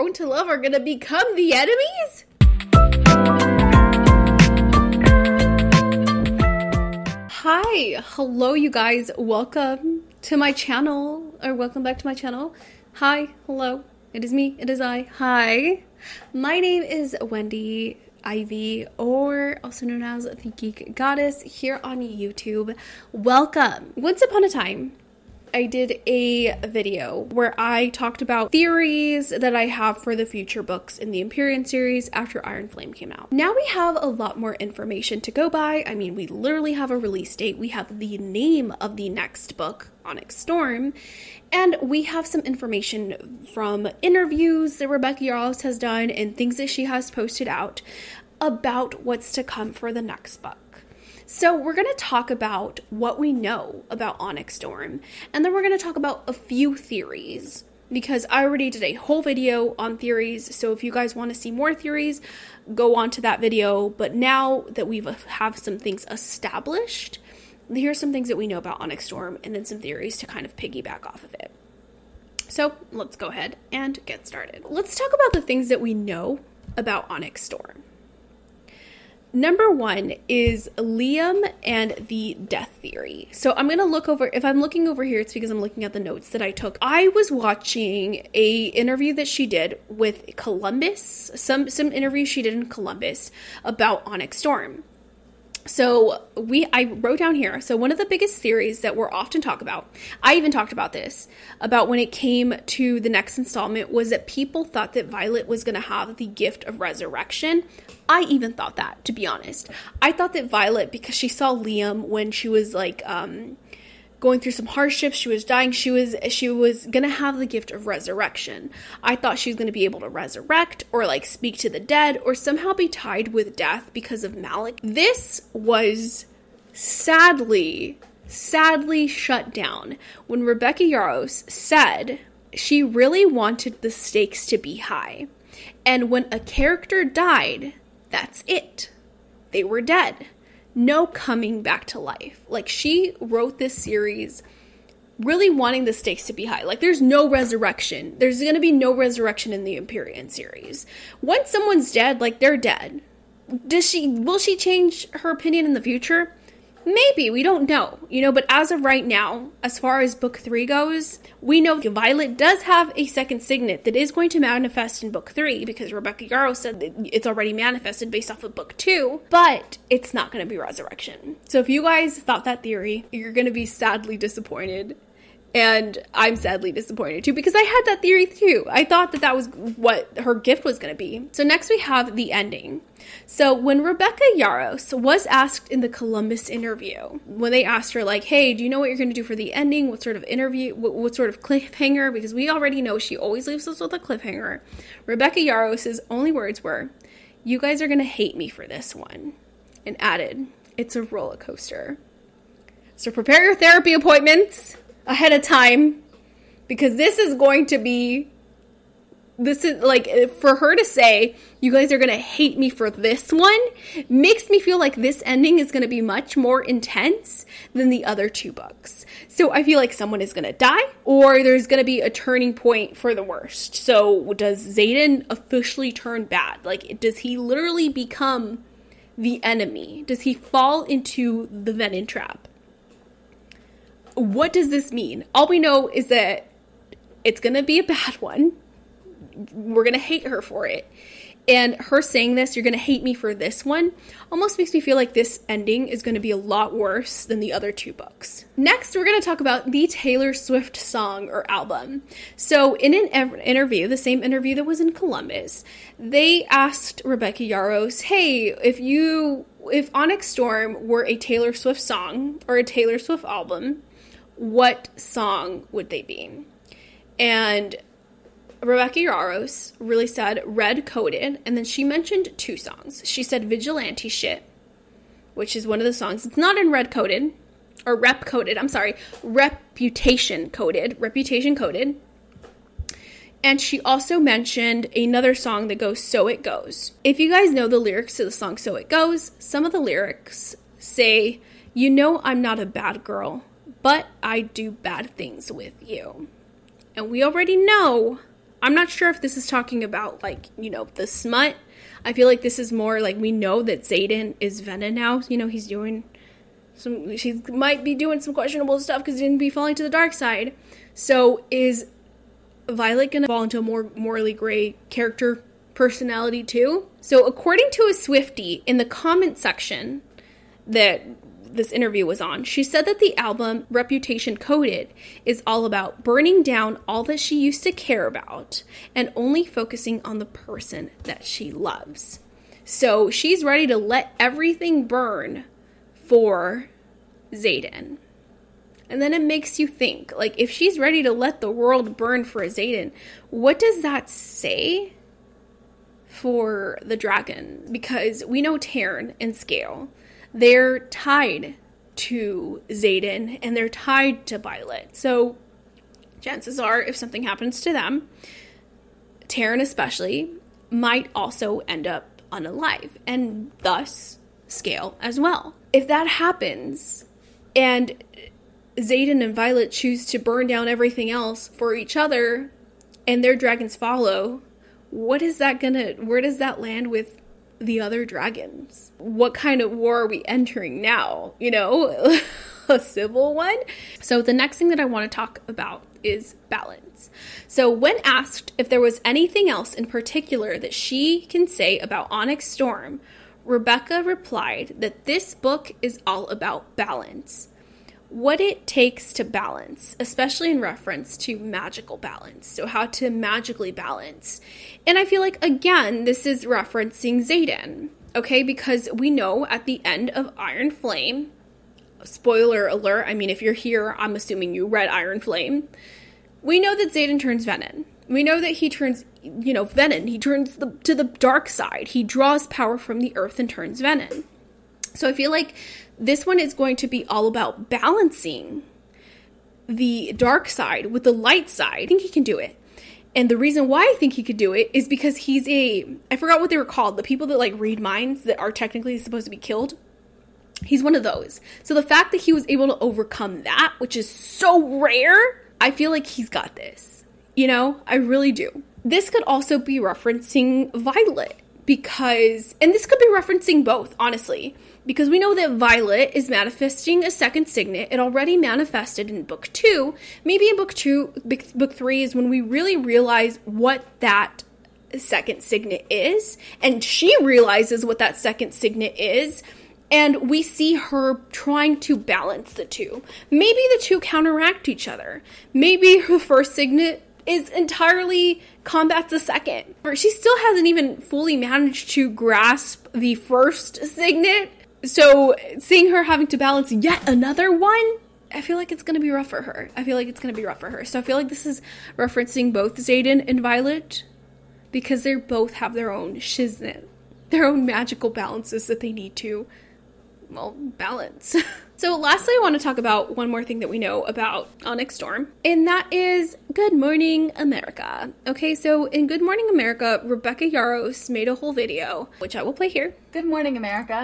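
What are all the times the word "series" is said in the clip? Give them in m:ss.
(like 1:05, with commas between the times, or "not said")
0:31, 2:23, 2:30.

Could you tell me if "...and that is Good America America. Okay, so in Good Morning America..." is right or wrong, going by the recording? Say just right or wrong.
wrong.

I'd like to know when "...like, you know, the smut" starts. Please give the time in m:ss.
5:00.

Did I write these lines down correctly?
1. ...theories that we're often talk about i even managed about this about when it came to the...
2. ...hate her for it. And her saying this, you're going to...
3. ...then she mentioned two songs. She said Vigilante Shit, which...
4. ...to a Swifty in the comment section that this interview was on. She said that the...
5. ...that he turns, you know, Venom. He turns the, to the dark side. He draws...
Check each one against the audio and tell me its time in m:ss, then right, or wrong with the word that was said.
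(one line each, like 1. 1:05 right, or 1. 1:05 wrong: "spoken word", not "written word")
1. 1:38 wrong: "talked", not "managed"
2. 3:59 right
3. 4:31 right
4. 5:17 right
5. 6:58 right.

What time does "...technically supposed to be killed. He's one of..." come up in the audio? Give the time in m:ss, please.
7:18.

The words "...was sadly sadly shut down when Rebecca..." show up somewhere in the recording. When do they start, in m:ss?
2:05.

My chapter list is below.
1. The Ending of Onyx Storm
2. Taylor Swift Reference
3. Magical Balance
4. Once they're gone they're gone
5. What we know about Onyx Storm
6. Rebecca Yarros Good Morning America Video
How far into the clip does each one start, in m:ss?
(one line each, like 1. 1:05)
1. 3:16
2. 4:12
3. 6:28
4. 2:04
5. 1:15
6. 8:23.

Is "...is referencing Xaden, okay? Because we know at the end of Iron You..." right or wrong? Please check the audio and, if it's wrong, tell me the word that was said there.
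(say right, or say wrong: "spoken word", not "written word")
wrong: "Flame", not "You".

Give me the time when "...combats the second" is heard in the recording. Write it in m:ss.
7:58.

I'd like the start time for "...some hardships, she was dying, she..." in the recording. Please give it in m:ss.
1:54.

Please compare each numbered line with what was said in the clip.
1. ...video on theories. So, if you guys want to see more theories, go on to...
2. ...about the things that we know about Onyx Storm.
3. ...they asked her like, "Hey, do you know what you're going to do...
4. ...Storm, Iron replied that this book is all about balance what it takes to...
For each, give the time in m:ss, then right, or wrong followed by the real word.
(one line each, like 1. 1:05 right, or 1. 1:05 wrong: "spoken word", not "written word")
1. 0:59 right
2. 1:15 right
3. 3:07 right
4. 6:32 wrong: "Rebecca", not "Iron".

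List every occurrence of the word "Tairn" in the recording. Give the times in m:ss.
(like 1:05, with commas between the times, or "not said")
5:48, 5:59.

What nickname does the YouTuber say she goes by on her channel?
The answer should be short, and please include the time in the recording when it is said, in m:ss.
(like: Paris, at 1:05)
the Geek Goddess, at 0:20.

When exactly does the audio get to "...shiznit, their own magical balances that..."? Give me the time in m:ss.
8:16.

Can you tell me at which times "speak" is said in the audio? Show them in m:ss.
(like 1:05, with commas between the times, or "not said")
2:01.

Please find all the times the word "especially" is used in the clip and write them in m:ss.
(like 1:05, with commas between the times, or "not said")
5:59, 6:40.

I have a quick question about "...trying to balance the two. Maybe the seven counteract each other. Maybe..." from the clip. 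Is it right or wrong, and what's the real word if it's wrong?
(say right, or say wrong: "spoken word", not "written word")
wrong: "two", not "seven".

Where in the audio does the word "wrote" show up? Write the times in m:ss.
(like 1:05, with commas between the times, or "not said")
1:36, 2:23.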